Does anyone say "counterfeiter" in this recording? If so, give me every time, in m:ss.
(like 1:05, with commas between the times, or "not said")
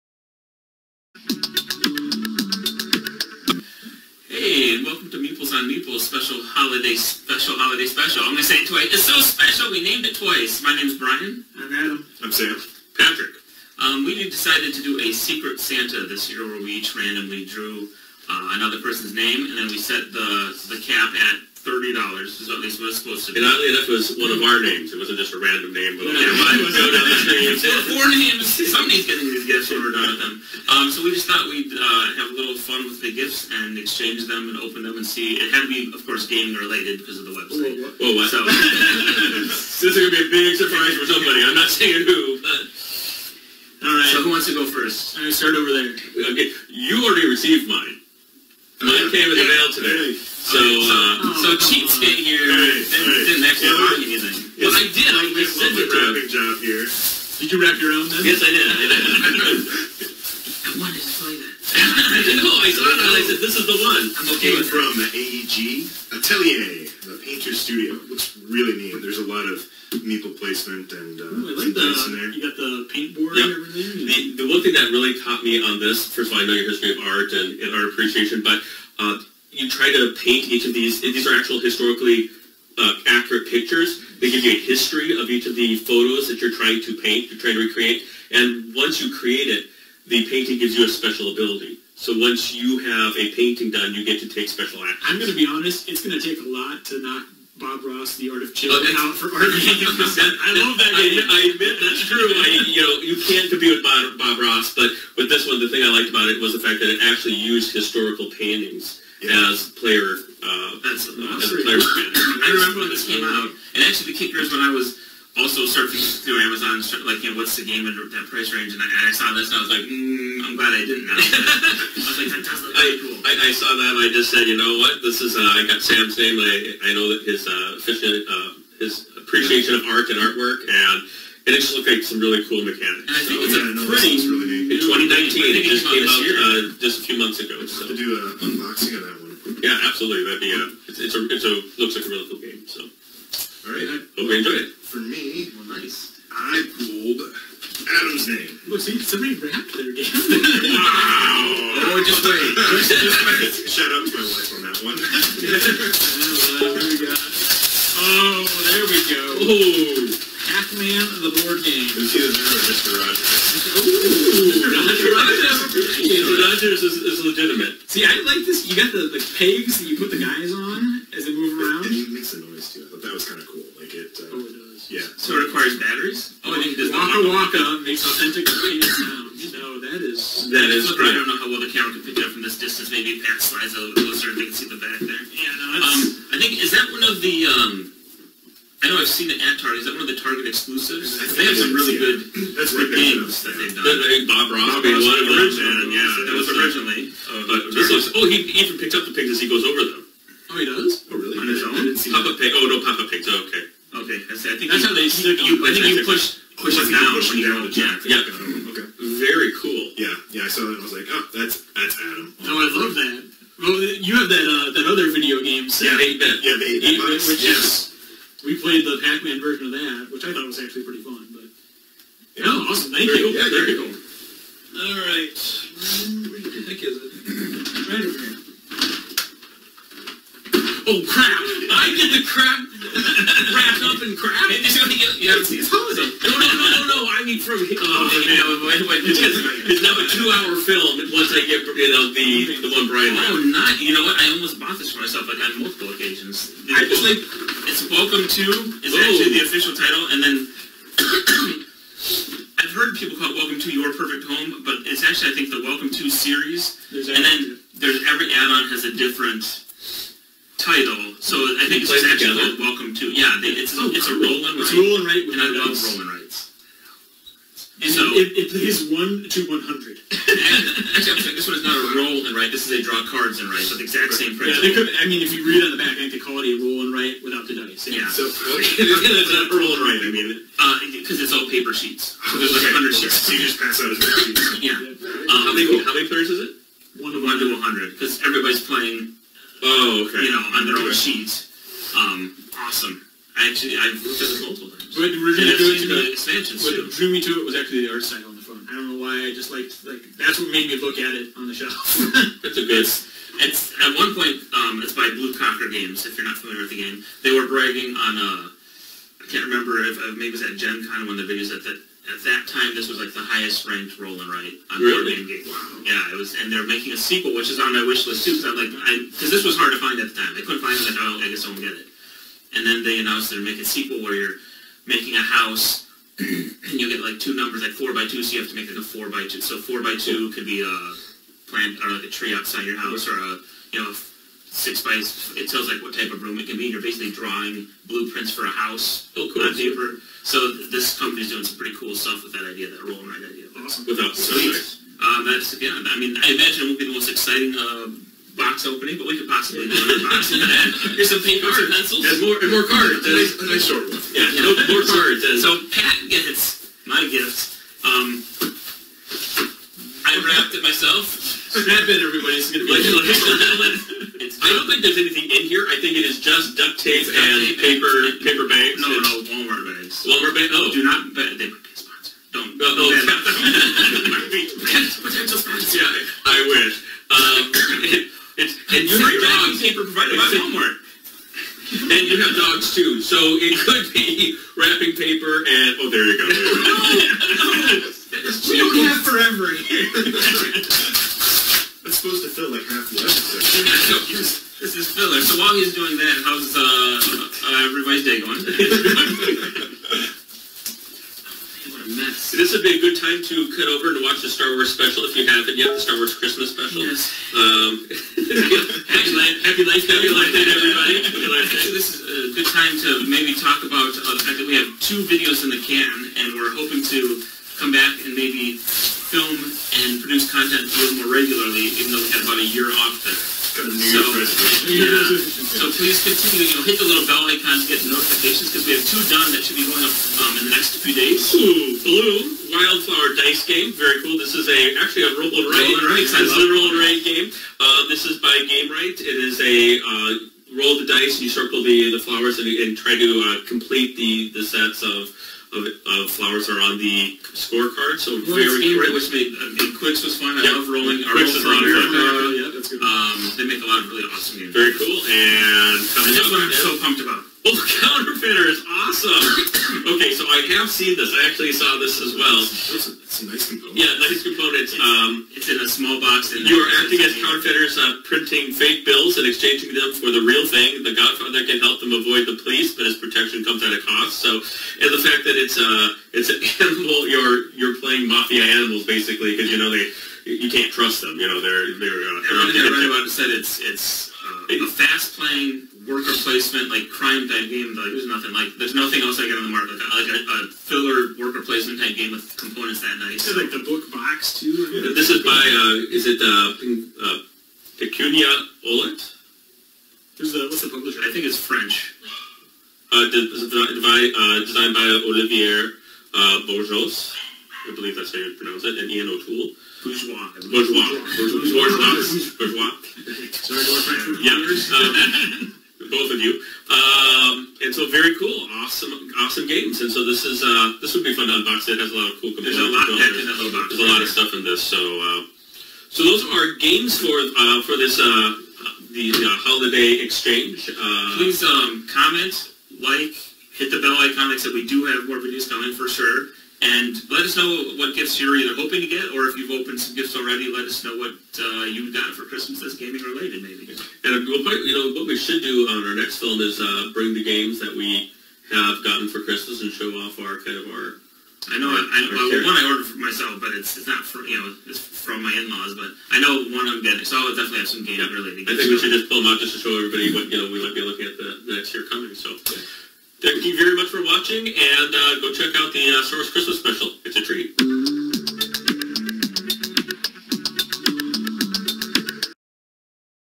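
7:37, 7:47.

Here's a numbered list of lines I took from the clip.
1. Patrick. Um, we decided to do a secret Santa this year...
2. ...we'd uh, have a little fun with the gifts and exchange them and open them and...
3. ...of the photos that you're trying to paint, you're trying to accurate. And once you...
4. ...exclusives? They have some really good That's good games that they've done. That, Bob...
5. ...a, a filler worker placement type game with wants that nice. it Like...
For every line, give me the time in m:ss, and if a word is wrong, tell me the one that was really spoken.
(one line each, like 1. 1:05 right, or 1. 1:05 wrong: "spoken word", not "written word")
1. 0:12 right
2. 0:31 right
3. 1:25 wrong: "recreate", not "accurate"
4. 3:10 right
5. 8:10 wrong: "components", not "wants".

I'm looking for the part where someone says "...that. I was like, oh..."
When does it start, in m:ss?
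3:30.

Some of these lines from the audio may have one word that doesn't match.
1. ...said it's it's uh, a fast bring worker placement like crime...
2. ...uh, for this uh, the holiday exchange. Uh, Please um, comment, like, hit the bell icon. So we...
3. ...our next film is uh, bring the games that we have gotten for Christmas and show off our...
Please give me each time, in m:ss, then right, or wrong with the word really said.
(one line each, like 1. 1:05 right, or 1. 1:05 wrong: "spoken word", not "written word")
1. 8:03 wrong: "playing", not "bring"
2. 8:47 right
3. 9:05 right.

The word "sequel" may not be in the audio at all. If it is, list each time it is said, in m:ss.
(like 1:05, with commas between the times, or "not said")
5:16, 5:23.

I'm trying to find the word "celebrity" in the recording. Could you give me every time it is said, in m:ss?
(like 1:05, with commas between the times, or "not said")
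not said.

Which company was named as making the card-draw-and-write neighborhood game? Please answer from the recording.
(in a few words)
Blue Cocker Games.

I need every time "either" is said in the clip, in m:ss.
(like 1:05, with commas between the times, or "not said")
2:42, 8:58.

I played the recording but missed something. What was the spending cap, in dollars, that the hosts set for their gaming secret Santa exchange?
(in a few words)
30.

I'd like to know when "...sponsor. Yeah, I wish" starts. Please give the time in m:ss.
6:15.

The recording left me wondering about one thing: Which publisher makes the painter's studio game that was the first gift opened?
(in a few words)
AEG.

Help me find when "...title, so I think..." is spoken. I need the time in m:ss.
4:20.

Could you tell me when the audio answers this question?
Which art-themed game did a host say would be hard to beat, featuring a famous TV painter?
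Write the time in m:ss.
1:37.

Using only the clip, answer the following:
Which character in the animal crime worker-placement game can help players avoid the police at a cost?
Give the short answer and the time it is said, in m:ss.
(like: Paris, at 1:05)
The Godfather, at 7:50.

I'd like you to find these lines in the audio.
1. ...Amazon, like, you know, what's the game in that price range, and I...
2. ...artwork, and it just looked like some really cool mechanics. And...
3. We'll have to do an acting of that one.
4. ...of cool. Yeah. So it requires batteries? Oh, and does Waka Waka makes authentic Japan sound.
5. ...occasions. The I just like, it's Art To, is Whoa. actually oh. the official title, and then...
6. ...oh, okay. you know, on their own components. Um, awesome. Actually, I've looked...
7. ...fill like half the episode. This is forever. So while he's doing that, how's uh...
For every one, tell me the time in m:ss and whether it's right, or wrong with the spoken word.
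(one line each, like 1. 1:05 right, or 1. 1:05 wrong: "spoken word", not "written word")
1. 1:56 right
2. 2:10 right
3. 2:17 wrong: "unboxing", not "acting"
4. 2:53 right
5. 4:05 wrong: "Welcome", not "Art"
6. 4:49 wrong: "sheets", not "components"
7. 6:32 wrong: "filler", not "forever".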